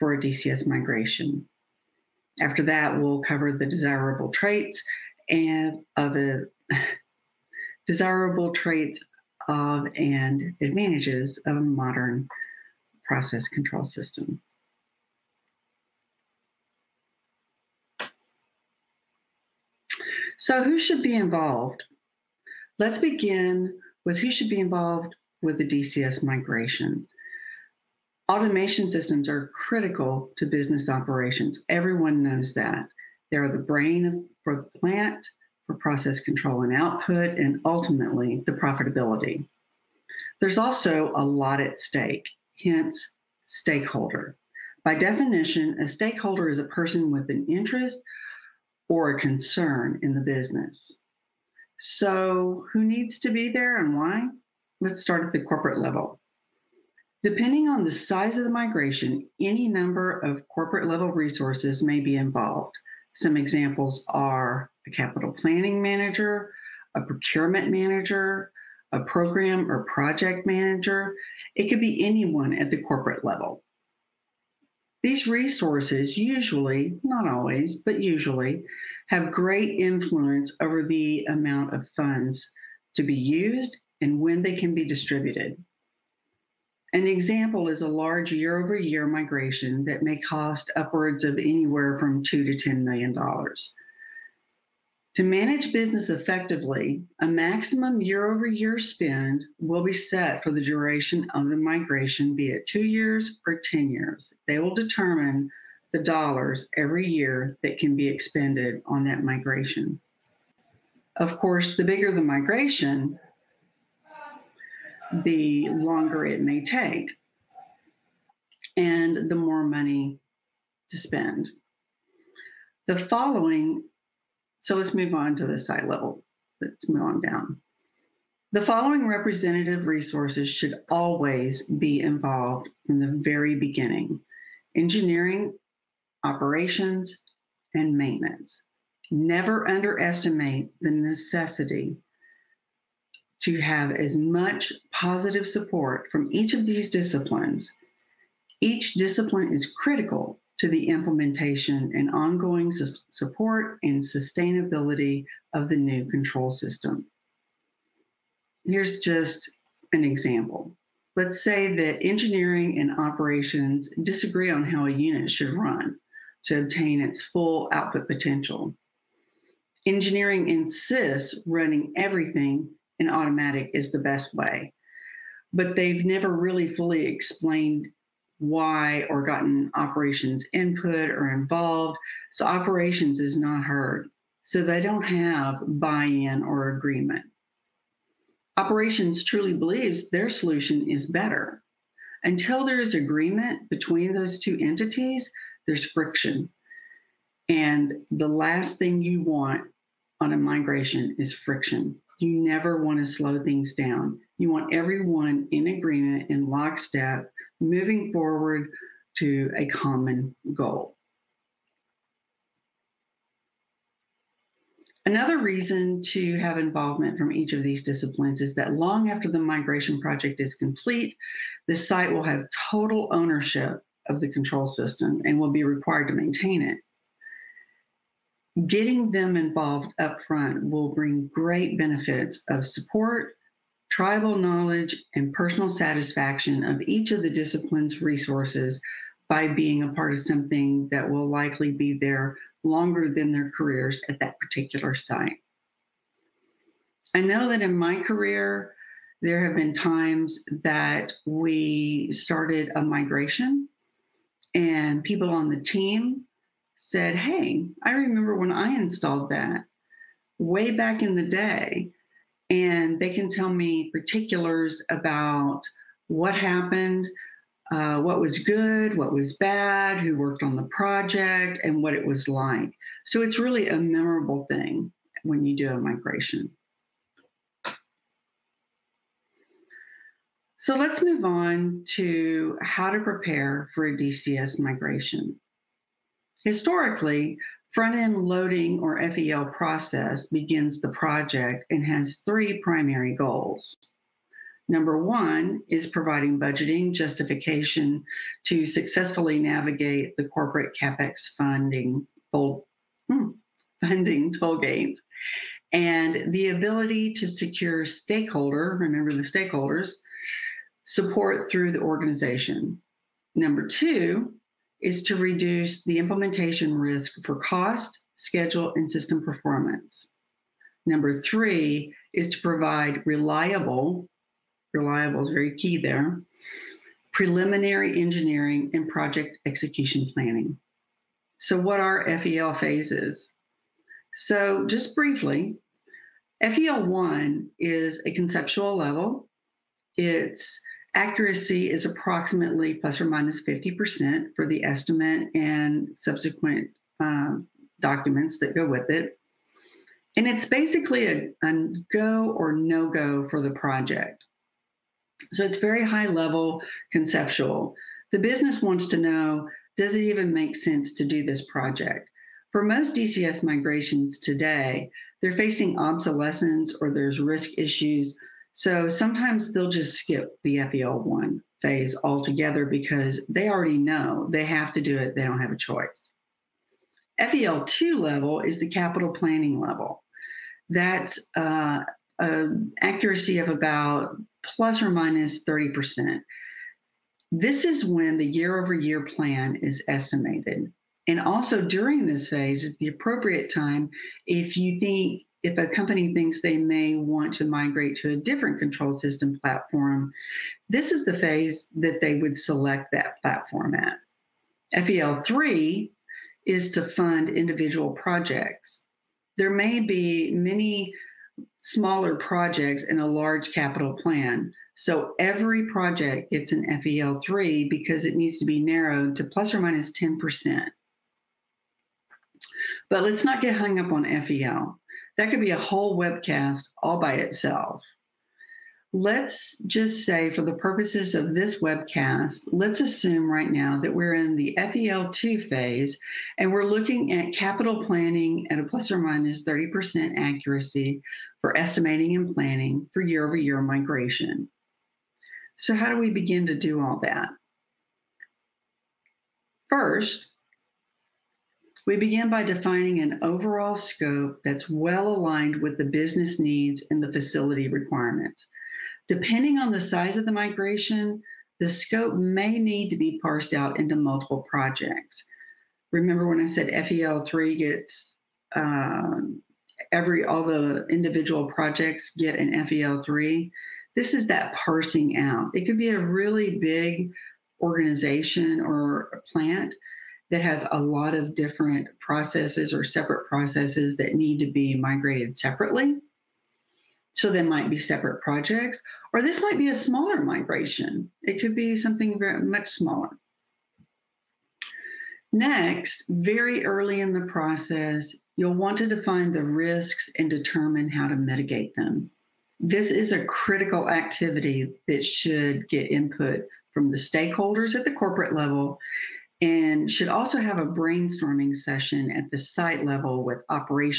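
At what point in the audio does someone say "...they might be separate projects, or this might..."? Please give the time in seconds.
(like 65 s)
487 s.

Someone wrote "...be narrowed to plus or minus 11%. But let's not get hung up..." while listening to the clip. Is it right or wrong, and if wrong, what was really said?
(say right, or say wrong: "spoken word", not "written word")
wrong: "10", not "11".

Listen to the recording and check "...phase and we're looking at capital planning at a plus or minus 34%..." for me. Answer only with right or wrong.
wrong.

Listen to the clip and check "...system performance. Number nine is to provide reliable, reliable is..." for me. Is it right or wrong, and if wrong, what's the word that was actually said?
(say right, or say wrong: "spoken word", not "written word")
wrong: "three", not "nine".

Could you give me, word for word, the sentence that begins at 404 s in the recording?
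FEL3 is to fund individual projects.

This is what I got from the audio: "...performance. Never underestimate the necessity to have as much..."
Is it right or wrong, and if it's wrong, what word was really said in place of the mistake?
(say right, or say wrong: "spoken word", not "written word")
wrong: "maintenance", not "performance".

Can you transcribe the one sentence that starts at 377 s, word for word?
FEL2 level is the capital planning level.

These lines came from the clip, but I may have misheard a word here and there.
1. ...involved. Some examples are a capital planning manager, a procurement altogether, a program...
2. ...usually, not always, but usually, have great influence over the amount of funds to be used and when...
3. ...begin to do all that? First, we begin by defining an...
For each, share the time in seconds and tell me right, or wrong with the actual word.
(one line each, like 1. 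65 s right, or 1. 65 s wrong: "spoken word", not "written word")
1. 62 s wrong: "manager", not "altogether"
2. 76 s right
3. 446 s right.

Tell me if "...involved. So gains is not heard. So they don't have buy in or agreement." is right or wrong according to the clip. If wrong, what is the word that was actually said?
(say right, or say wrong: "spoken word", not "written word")
wrong: "operations", not "gains".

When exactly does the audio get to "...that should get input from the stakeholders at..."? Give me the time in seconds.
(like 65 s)
504 s.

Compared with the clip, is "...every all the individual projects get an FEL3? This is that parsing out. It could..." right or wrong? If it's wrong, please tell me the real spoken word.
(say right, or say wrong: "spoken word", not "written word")
right.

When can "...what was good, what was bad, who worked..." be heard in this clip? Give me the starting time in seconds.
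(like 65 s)
268 s.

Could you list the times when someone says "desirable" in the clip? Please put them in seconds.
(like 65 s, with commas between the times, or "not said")
3 s, 7 s.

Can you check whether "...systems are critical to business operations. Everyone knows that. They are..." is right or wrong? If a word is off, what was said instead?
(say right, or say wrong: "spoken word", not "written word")
right.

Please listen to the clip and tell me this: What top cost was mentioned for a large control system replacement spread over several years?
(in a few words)
$10 million.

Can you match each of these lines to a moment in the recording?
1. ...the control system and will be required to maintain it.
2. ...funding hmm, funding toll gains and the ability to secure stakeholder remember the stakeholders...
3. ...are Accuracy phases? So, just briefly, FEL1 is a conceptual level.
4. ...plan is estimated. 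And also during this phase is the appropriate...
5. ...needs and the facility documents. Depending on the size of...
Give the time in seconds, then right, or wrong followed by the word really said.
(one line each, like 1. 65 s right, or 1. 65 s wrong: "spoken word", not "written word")
1. 224 s right
2. 301 s right
3. 331 s wrong: "FEL", not "Accuracy"
4. 389 s right
5. 456 s wrong: "requirements", not "documents".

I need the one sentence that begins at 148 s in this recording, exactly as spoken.
Each discipline is critical to the implementation and ongoing su- support and sustainability of the new control system.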